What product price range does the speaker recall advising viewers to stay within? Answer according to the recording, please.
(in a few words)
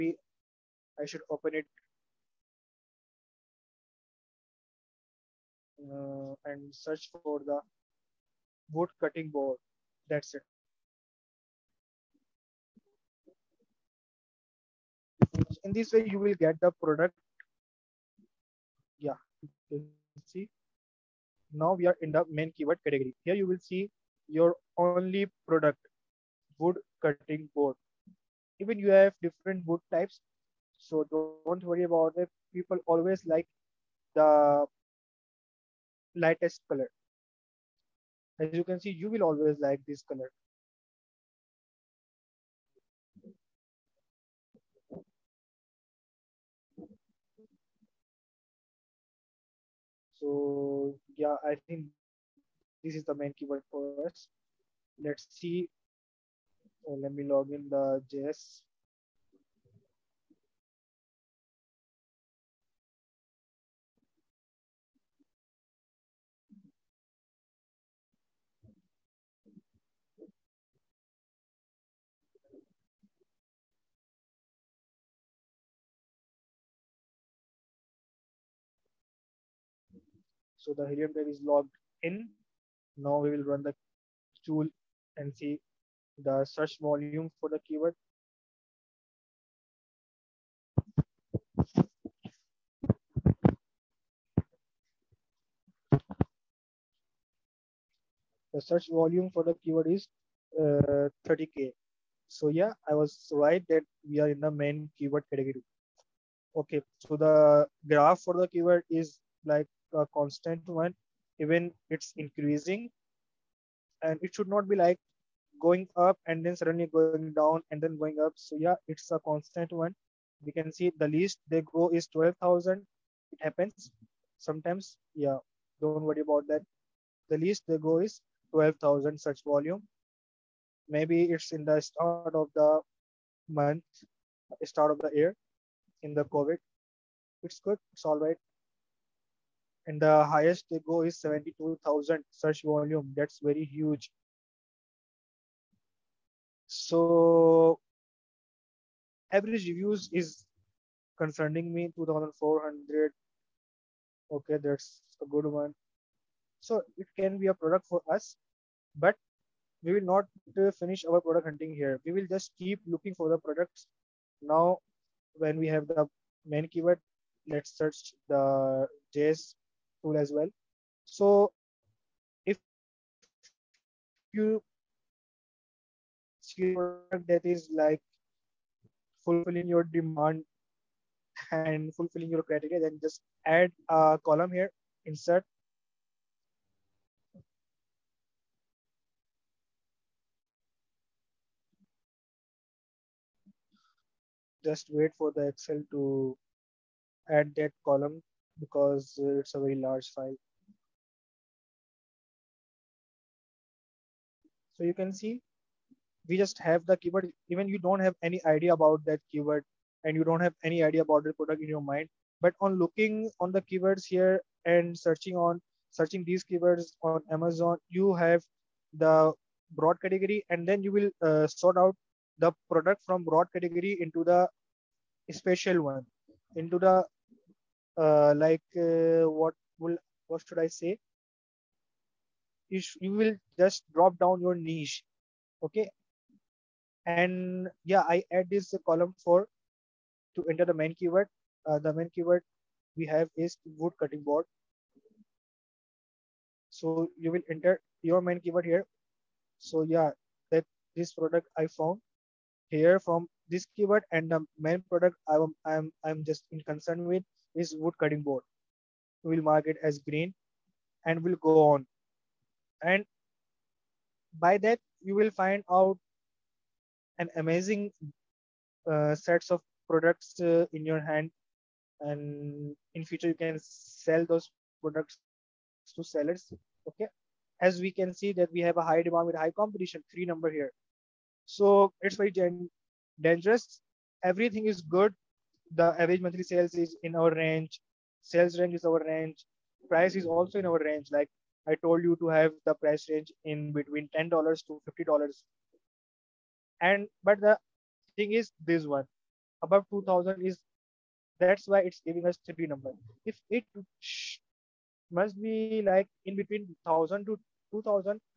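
$10 to $50.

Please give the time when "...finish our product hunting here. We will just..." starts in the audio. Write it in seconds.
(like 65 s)
160 s.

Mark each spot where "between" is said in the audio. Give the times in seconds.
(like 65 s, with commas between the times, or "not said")
293 s, 306 s.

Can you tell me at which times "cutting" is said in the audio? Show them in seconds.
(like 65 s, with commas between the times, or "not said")
8 s, 27 s, 243 s, 257 s.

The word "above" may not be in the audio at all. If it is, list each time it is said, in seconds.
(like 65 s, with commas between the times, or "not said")
299 s.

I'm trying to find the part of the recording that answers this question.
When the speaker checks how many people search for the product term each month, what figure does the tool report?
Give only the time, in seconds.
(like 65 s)
101 s.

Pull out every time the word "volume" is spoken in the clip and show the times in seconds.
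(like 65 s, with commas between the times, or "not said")
86 s, 98 s, 129 s, 142 s.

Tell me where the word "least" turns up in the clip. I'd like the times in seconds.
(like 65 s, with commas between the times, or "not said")
121 s, 127 s.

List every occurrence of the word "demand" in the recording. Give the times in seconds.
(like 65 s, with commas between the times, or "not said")
179 s, 279 s.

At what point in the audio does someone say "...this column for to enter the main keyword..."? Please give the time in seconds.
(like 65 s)
238 s.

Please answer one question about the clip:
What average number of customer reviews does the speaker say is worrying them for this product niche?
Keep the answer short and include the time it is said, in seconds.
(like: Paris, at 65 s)
2,400, at 151 s.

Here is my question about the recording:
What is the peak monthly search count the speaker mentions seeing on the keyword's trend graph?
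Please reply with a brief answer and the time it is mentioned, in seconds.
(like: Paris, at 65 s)
72,000, at 141 s.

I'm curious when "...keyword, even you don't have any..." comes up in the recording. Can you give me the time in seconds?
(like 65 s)
206 s.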